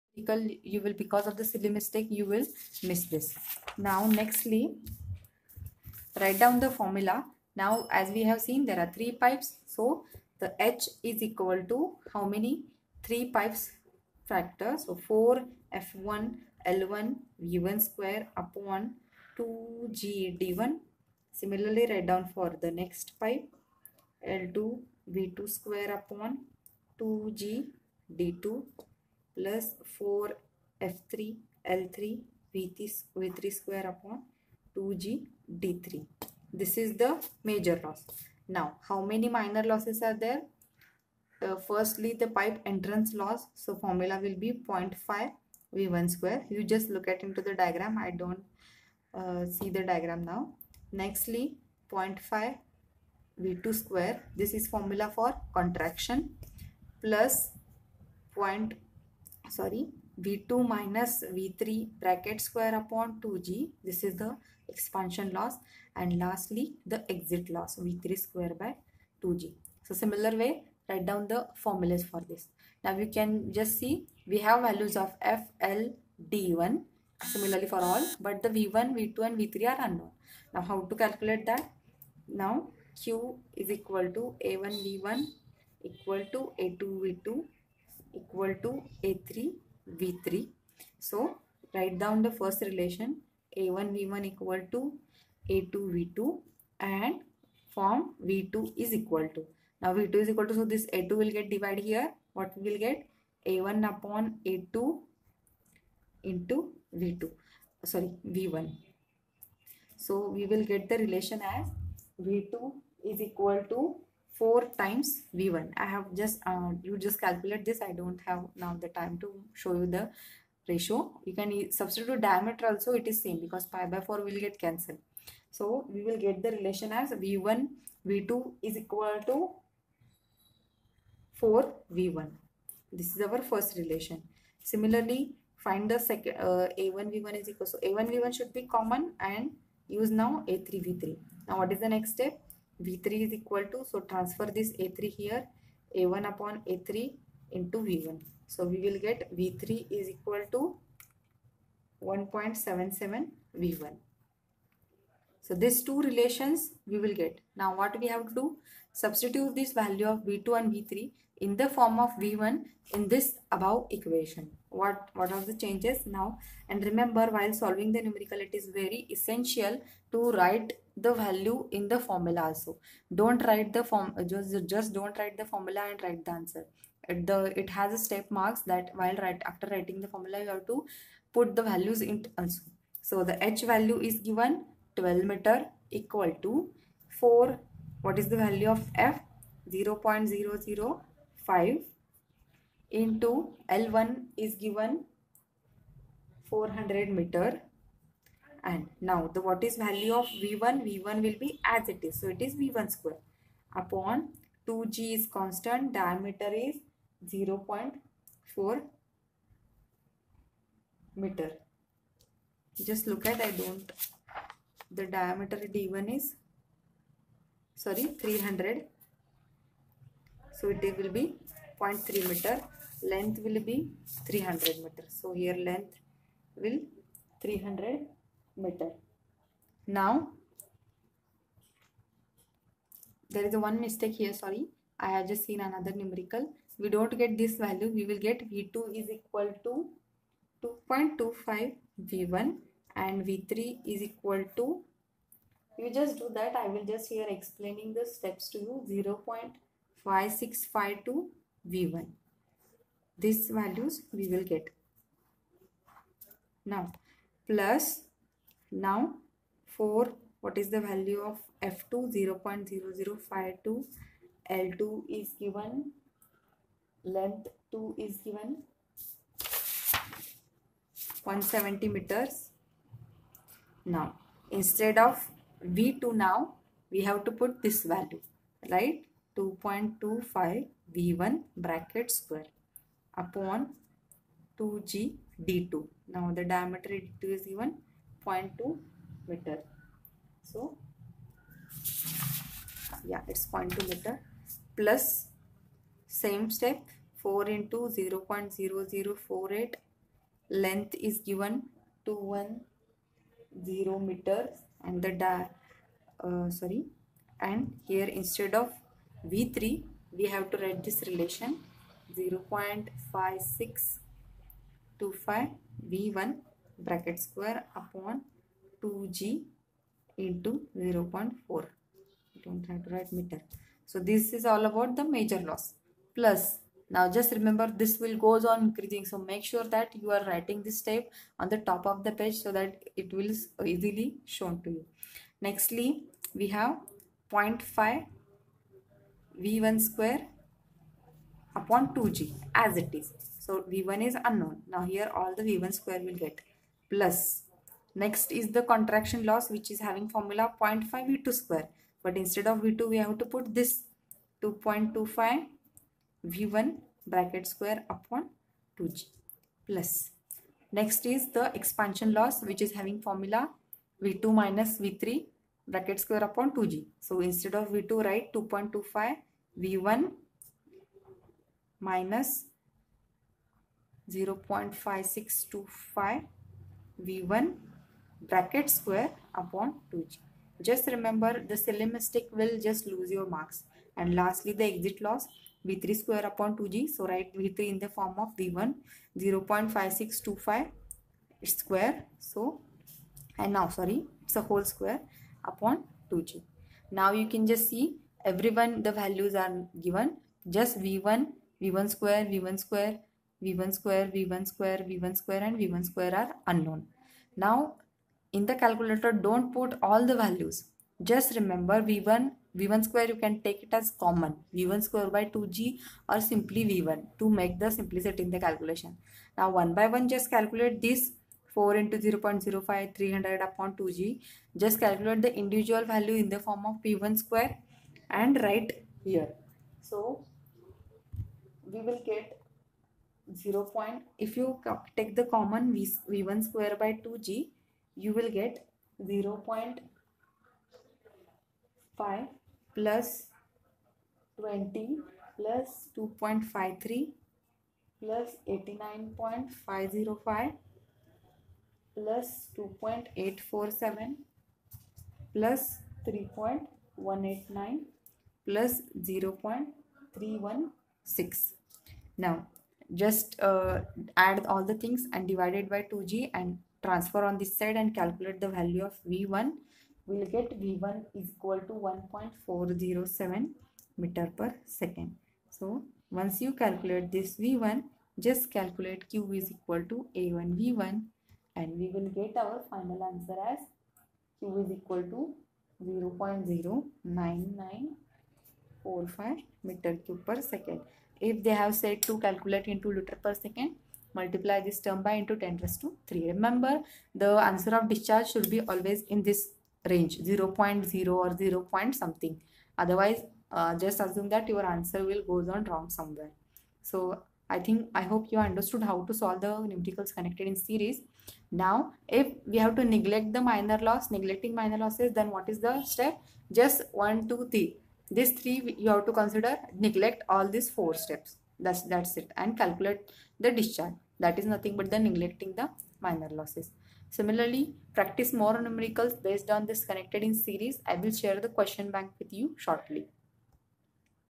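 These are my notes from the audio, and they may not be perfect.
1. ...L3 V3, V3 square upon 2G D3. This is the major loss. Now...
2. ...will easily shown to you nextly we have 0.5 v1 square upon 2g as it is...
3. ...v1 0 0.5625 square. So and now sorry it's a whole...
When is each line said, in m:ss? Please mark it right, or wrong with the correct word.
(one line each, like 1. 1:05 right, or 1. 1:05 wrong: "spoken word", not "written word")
1. 0:31 right
2. 5:33 right
3. 6:28 right.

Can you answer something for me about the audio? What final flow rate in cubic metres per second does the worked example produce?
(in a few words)
0.09945 m³/s.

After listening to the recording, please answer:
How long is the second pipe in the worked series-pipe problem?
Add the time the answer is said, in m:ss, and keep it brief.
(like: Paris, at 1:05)
170 meters, at 4:31.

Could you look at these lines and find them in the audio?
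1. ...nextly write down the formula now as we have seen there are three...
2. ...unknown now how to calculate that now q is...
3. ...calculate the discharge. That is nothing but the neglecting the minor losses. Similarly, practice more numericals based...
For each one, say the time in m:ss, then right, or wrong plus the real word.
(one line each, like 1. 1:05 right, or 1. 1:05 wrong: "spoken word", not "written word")
1. 0:04 right
2. 1:19 right
3. 8:42 right.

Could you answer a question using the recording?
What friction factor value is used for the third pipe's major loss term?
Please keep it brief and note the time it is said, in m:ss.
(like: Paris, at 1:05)
0.0048, at 4:57.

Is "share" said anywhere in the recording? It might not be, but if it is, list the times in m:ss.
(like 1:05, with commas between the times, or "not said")
8:51.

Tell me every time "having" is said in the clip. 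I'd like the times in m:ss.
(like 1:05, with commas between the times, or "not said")
5:49, 6:02.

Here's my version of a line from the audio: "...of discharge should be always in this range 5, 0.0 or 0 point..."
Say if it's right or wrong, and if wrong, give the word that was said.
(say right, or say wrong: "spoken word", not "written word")
wrong: "0", not "5".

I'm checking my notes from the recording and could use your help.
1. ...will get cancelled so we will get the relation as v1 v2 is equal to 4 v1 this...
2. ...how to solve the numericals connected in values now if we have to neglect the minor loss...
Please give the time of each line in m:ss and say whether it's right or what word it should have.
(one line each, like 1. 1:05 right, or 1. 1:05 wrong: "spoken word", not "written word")
1. 2:04 right
2. 8:28 wrong: "series", not "values".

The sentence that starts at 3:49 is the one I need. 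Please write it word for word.
Now, there is a one mistake here, sorry.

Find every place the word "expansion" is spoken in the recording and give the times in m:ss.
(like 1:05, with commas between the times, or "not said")
1:04, 6:01.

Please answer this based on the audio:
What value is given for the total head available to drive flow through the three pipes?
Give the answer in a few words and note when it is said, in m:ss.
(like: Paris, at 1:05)
12 meters, at 3:04.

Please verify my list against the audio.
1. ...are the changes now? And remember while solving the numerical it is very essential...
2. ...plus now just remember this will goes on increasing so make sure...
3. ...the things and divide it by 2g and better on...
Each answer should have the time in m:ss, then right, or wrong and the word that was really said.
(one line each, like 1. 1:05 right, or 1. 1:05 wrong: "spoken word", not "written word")
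1. 2:45 right
2. 5:26 right
3. 7:44 wrong: "transfer", not "better".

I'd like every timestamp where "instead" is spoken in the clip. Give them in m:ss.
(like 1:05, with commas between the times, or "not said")
4:34, 5:08, 5:52, 6:07.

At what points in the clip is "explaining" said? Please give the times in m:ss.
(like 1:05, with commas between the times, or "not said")
4:07.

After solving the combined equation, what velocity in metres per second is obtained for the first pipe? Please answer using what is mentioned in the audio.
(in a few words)
1.407 m/s.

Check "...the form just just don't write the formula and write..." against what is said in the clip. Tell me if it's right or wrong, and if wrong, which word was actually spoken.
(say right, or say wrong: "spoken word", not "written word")
right.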